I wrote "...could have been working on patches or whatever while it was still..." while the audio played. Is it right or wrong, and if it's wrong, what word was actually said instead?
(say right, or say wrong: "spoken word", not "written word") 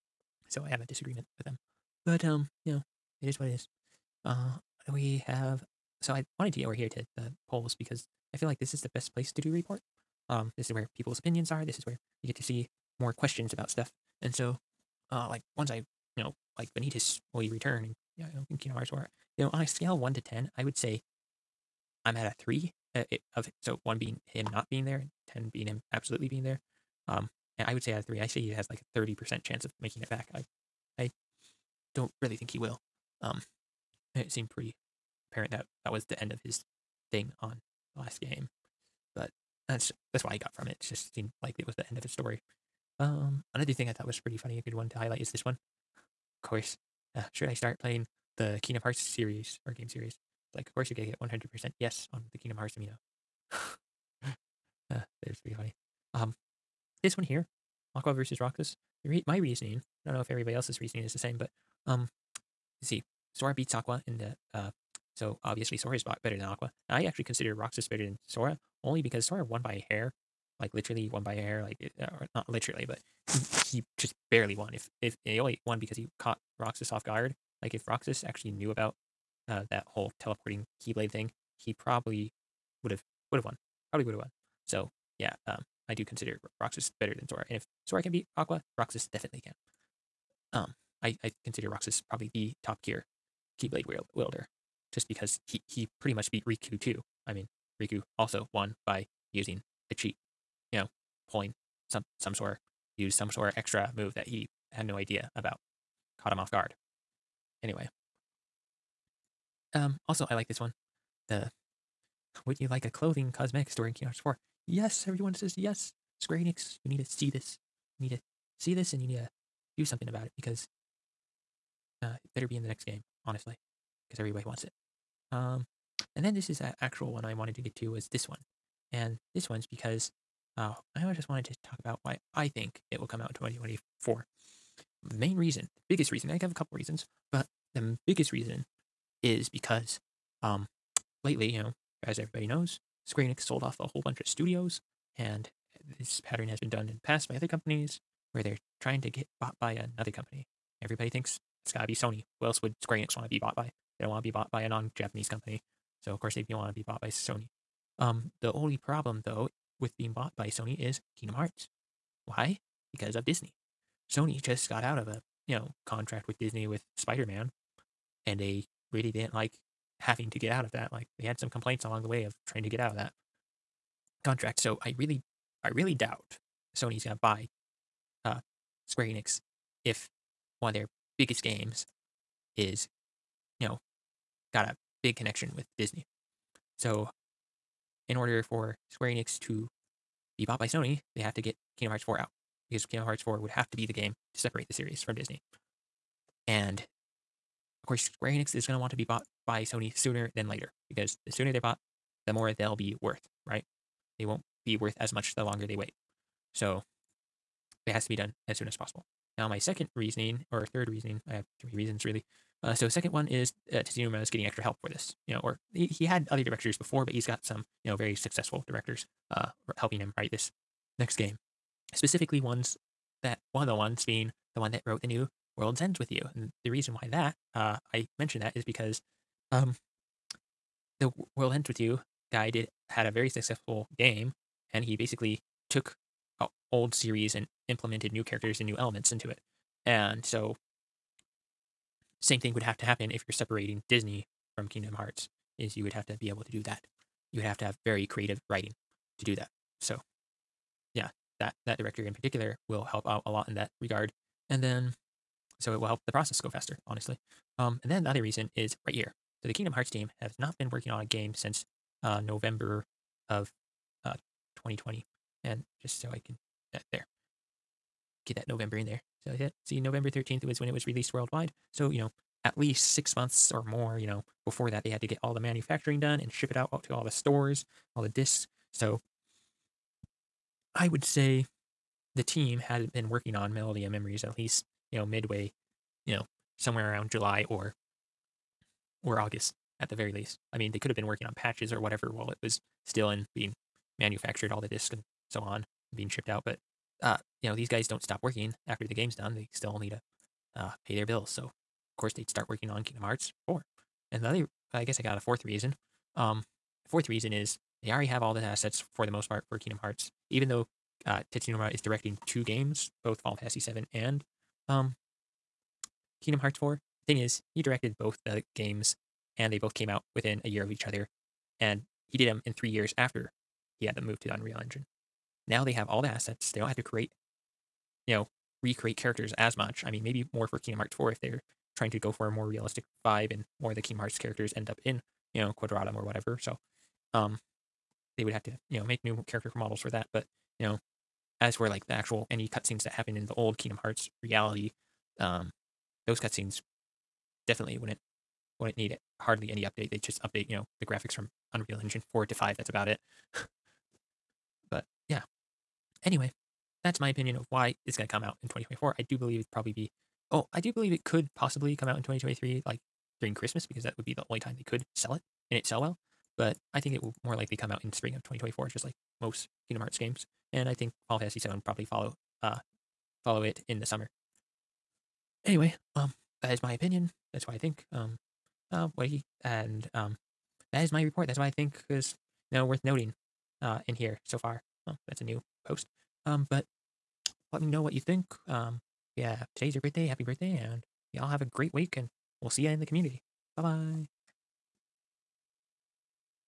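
right.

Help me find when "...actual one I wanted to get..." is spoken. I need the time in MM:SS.
02:06.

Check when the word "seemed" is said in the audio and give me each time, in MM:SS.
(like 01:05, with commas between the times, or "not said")
00:34, 00:41.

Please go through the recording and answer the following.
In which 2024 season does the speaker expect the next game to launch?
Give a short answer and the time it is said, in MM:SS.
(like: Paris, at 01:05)
Spring, at 06:07.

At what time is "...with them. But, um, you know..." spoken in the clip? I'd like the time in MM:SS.
00:01.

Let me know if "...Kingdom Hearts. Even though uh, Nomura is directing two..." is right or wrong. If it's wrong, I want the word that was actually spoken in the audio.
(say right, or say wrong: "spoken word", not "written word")
right.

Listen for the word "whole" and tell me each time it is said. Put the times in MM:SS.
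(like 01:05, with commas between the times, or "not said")
01:19, 02:23.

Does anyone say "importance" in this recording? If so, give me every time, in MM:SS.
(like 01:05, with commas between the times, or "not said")
not said.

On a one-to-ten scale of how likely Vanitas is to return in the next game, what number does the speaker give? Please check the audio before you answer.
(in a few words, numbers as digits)
3.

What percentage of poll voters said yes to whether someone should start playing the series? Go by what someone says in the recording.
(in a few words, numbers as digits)
100%.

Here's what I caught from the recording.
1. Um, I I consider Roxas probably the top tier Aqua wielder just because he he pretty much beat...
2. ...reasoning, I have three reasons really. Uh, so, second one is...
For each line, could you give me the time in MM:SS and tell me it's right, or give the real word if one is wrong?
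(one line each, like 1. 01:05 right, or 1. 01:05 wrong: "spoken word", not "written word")
1. 01:30 wrong: "Keyblade", not "Aqua"
2. 03:30 right.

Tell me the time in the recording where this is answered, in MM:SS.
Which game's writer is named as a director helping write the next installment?
03:45.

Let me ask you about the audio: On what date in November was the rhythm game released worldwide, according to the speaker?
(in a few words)
November 13th.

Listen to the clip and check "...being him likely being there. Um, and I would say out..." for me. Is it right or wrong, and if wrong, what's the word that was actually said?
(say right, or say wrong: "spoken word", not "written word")
wrong: "absolutely", not "likely".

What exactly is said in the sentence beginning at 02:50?
Like they had some complaints along the way of trying to get out of that contract.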